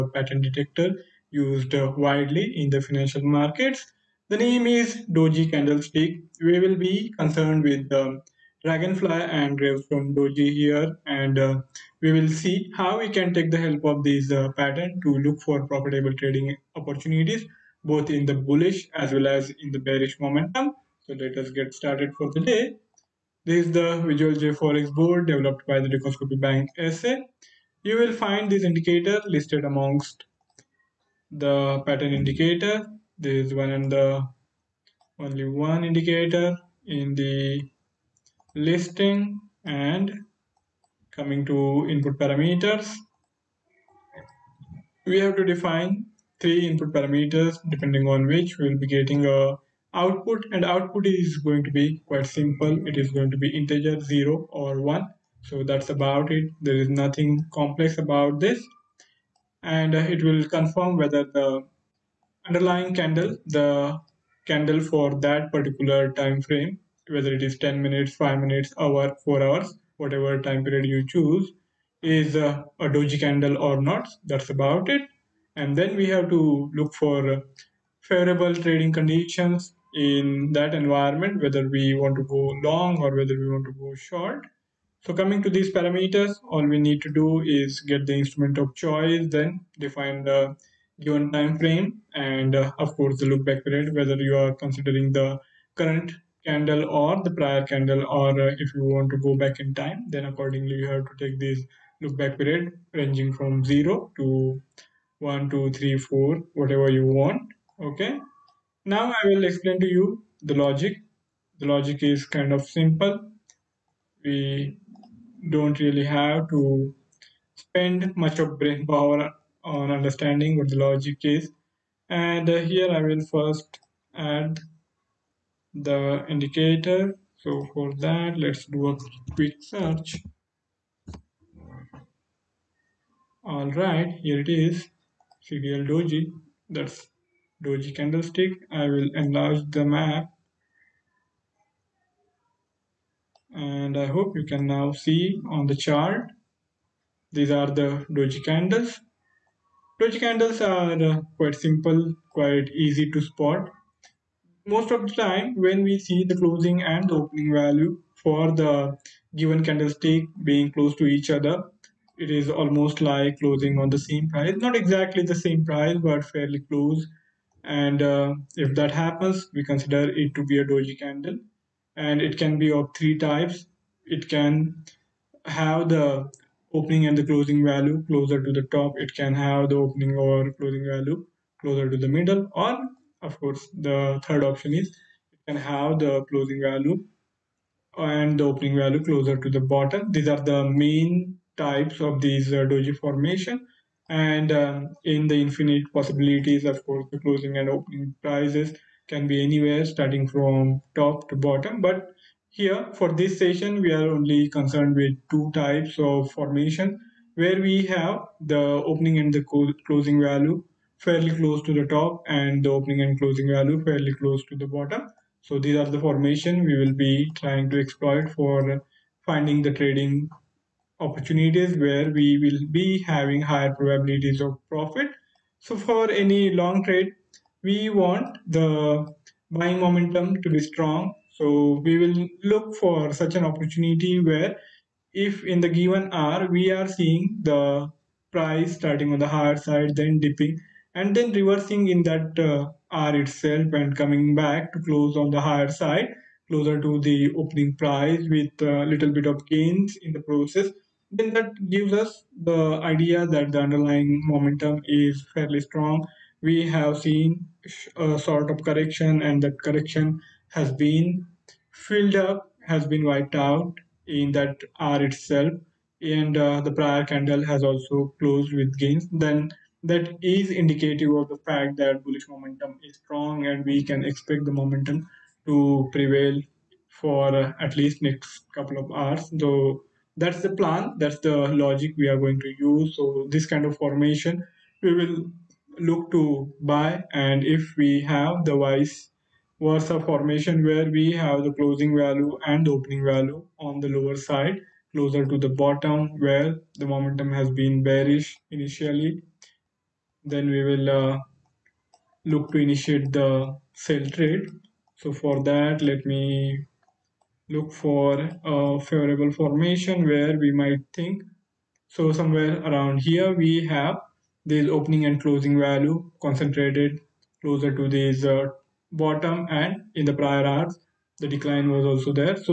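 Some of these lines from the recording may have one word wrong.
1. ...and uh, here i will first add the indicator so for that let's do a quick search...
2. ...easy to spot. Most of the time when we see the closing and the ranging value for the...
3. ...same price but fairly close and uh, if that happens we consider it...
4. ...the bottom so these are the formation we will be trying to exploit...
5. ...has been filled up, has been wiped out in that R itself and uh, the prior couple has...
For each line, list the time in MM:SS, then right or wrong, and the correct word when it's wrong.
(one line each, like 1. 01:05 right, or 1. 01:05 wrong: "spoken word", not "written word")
1. 02:02 right
2. 02:32 wrong: "opening", not "ranging"
3. 02:45 right
4. 03:34 right
5. 04:20 wrong: "candle", not "couple".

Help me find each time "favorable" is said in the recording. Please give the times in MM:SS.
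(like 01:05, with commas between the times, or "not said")
01:18, 05:08.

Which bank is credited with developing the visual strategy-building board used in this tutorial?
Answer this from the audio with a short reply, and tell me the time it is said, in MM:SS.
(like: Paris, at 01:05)
Dukascopy Bank SA, at 00:25.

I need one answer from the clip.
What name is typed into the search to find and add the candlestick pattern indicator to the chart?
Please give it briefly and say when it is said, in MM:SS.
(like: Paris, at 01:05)
CDL doji, at 02:15.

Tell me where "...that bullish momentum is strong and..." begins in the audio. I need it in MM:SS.
04:31.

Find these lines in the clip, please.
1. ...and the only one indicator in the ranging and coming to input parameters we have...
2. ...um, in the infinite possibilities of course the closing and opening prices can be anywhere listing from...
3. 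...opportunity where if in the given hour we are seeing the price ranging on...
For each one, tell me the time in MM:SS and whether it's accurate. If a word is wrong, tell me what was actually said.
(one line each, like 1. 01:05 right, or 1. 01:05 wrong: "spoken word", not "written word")
1. 00:33 wrong: "listing", not "ranging"
2. 03:14 wrong: "starting", not "listing"
3. 03:53 wrong: "starting", not "ranging".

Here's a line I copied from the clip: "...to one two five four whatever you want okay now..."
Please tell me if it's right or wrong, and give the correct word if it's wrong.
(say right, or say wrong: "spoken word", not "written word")
wrong: "three", not "five".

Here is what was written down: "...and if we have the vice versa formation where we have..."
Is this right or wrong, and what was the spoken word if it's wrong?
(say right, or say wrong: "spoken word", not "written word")
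right.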